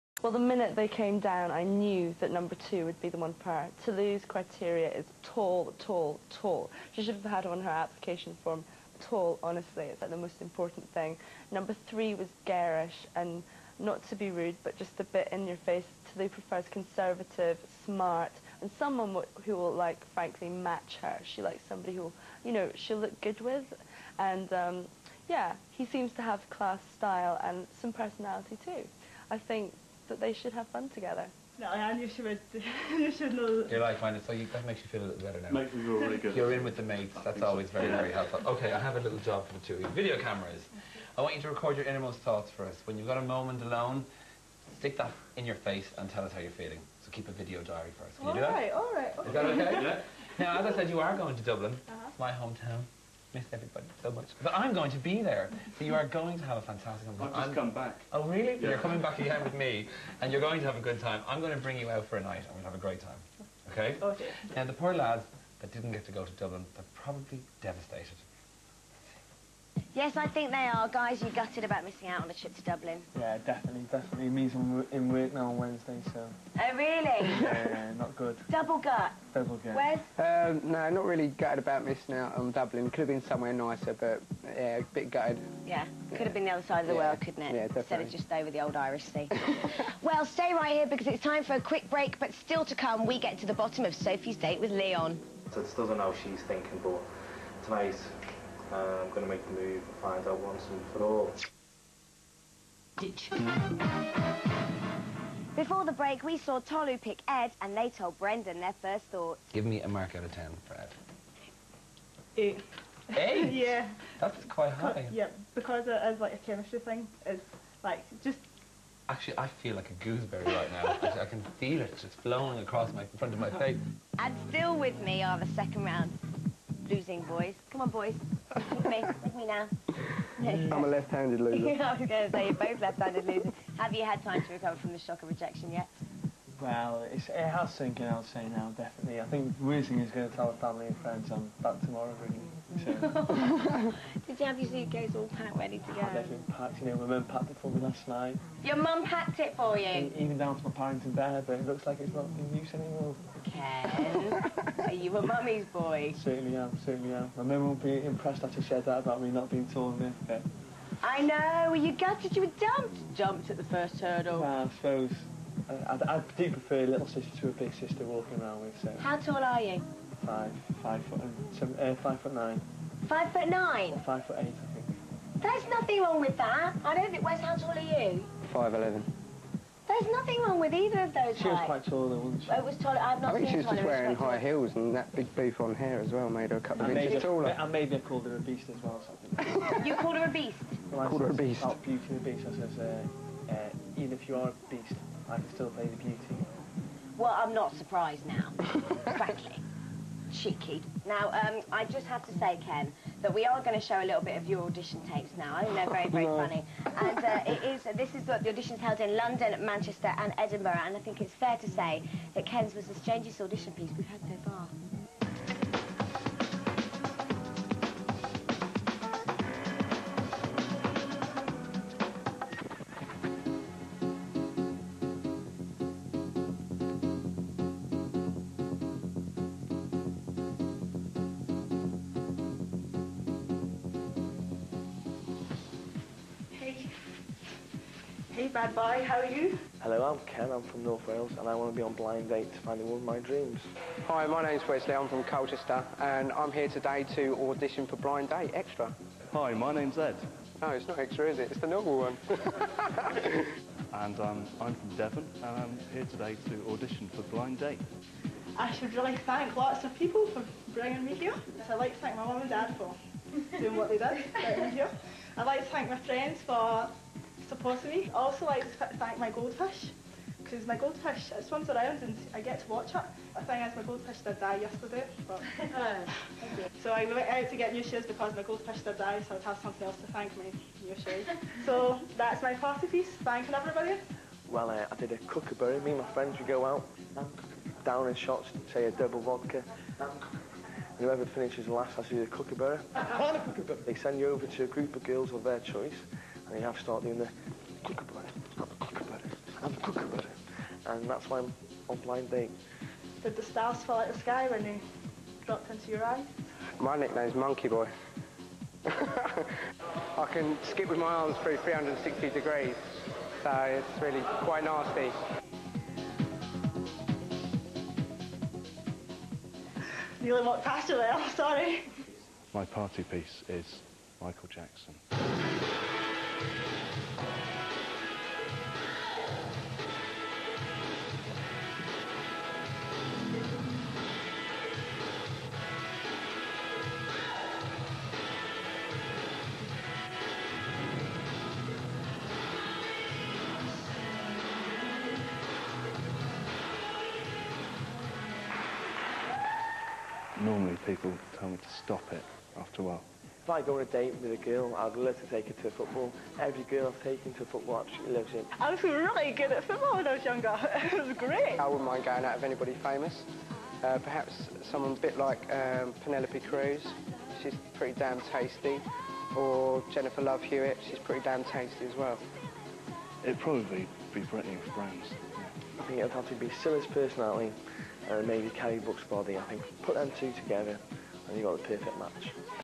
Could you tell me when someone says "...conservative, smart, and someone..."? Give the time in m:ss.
0:16.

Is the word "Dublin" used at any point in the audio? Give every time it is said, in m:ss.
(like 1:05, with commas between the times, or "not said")
0:51, 1:06, 1:12, 1:22.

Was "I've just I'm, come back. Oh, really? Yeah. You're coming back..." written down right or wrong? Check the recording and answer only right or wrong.
right.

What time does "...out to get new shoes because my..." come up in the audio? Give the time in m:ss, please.
4:37.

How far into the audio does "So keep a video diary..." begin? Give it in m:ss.
0:47.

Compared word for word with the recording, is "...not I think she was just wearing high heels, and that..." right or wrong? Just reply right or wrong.
right.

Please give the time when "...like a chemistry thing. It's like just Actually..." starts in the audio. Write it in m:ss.
1:56.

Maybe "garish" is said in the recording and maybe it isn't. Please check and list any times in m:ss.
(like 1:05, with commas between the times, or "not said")
0:12.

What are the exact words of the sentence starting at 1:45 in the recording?
Before the break, we saw Tolu pick Ed, and they told Brendan their first thoughts.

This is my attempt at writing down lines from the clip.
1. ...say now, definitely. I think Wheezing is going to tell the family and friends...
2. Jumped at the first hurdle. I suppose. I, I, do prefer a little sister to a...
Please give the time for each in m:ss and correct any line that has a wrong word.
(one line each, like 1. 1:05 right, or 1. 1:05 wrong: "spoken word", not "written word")
1. 2:18 right
2. 2:43 right.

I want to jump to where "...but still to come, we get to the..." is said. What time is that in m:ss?
1:32.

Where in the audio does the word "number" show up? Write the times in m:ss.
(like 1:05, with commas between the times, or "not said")
0:02, 0:11.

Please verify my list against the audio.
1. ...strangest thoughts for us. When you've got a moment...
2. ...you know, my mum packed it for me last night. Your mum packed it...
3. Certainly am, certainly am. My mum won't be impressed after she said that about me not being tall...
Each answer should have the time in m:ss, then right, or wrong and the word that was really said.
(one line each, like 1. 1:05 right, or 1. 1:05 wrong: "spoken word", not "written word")
1. 0:41 wrong: "innermost", not "strangest"
2. 2:26 right
3. 2:36 right.